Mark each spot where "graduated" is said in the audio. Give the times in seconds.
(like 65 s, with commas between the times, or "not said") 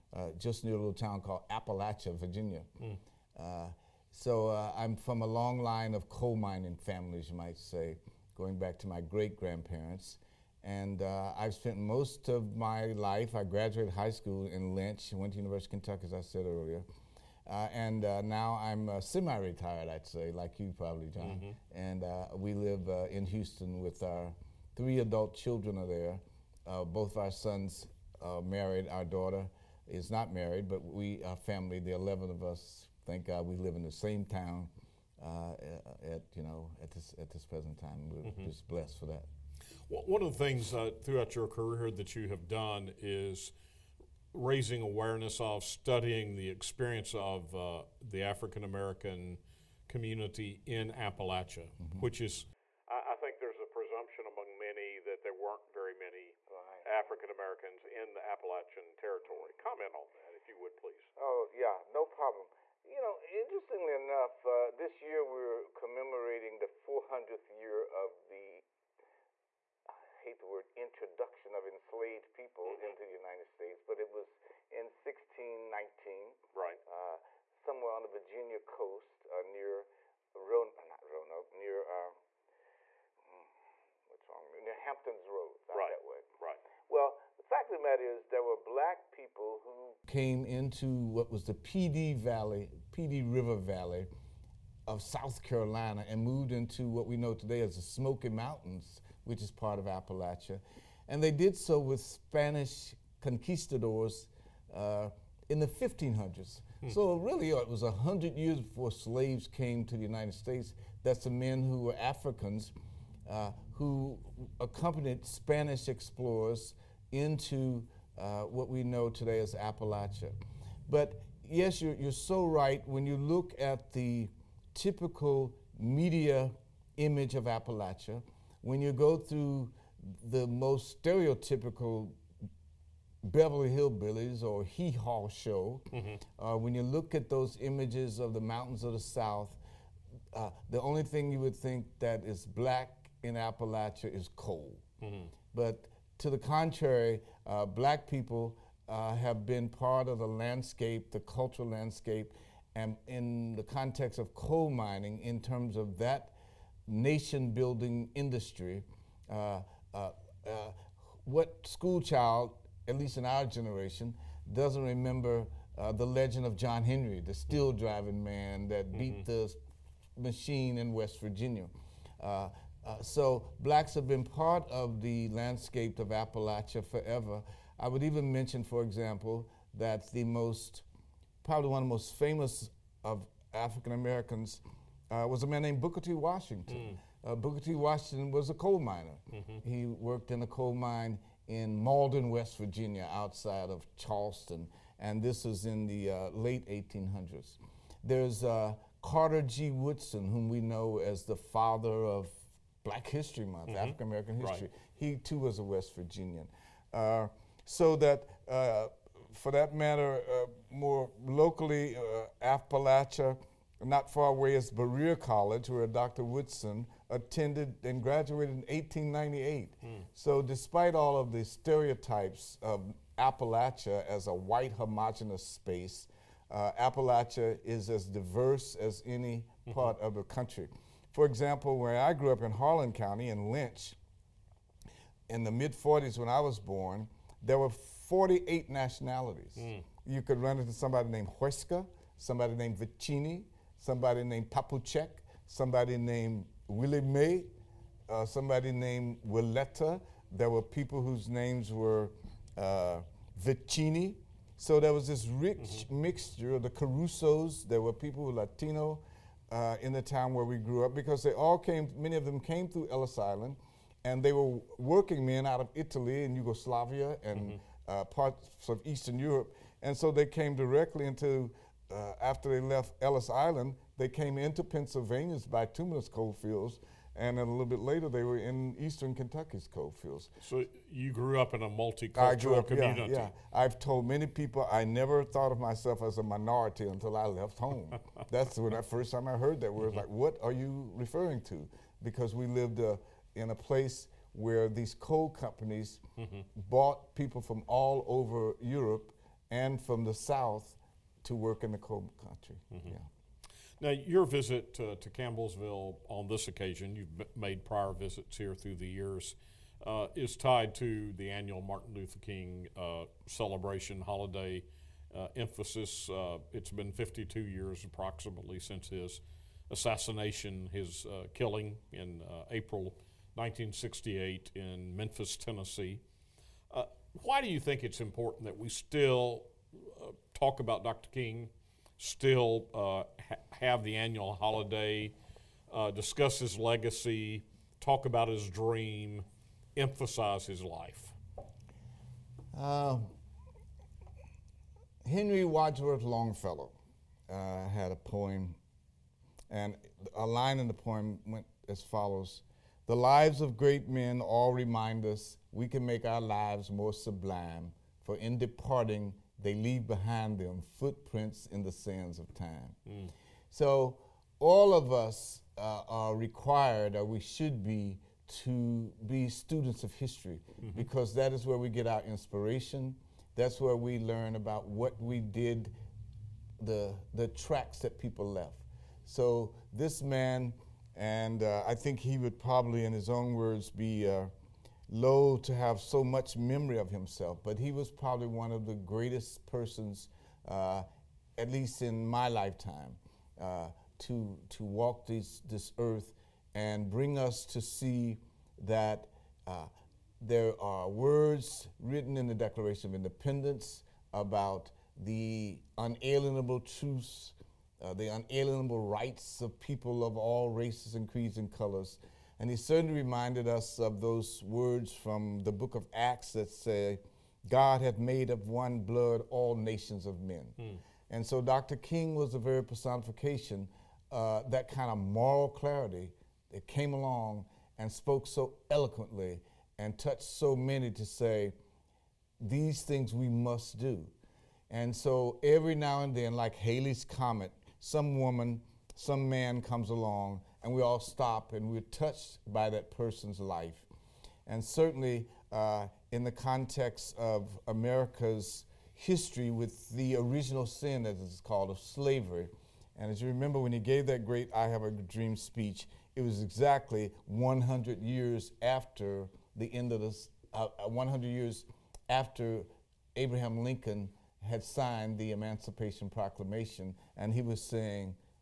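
13 s, 218 s.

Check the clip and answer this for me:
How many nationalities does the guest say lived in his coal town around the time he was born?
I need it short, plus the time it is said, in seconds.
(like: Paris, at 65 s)
48, at 238 s.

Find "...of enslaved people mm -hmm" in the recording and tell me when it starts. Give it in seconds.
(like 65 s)
71 s.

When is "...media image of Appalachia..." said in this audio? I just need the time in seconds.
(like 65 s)
125 s.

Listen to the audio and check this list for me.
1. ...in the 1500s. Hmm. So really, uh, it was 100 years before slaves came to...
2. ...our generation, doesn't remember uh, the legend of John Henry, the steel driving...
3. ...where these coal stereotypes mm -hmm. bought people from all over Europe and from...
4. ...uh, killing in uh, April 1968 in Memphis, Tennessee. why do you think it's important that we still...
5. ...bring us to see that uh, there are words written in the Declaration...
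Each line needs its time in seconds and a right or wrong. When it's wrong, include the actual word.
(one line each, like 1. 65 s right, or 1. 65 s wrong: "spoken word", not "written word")
1. 105 s right
2. 163 s right
3. 294 s wrong: "companies", not "stereotypes"
4. 321 s right
5. 396 s right.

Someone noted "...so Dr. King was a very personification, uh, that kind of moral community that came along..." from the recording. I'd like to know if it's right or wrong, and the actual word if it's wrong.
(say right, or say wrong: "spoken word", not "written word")
wrong: "clarity", not "community".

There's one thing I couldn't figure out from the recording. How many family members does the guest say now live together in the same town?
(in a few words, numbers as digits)
11.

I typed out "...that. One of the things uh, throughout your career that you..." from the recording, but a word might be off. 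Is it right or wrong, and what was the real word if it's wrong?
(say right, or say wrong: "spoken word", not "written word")
right.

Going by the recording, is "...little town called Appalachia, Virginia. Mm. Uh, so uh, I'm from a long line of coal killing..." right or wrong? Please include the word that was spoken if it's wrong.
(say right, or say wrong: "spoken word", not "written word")
wrong: "mining", not "killing".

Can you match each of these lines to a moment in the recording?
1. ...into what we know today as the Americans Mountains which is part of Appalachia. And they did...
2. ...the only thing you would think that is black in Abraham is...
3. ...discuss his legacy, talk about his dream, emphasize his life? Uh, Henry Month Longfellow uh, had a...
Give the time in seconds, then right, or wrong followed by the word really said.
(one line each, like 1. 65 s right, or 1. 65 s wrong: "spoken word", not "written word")
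1. 96 s wrong: "Smoky", not "Americans"
2. 140 s wrong: "Appalachia", not "Abraham"
3. 335 s wrong: "Wadsworth", not "Month".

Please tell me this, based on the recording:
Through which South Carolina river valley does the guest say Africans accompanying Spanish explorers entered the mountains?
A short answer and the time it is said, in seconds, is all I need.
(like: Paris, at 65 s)
Pee Dee River Valley, at 92 s.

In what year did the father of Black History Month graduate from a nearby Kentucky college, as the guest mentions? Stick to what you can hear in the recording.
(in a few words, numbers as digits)
1898.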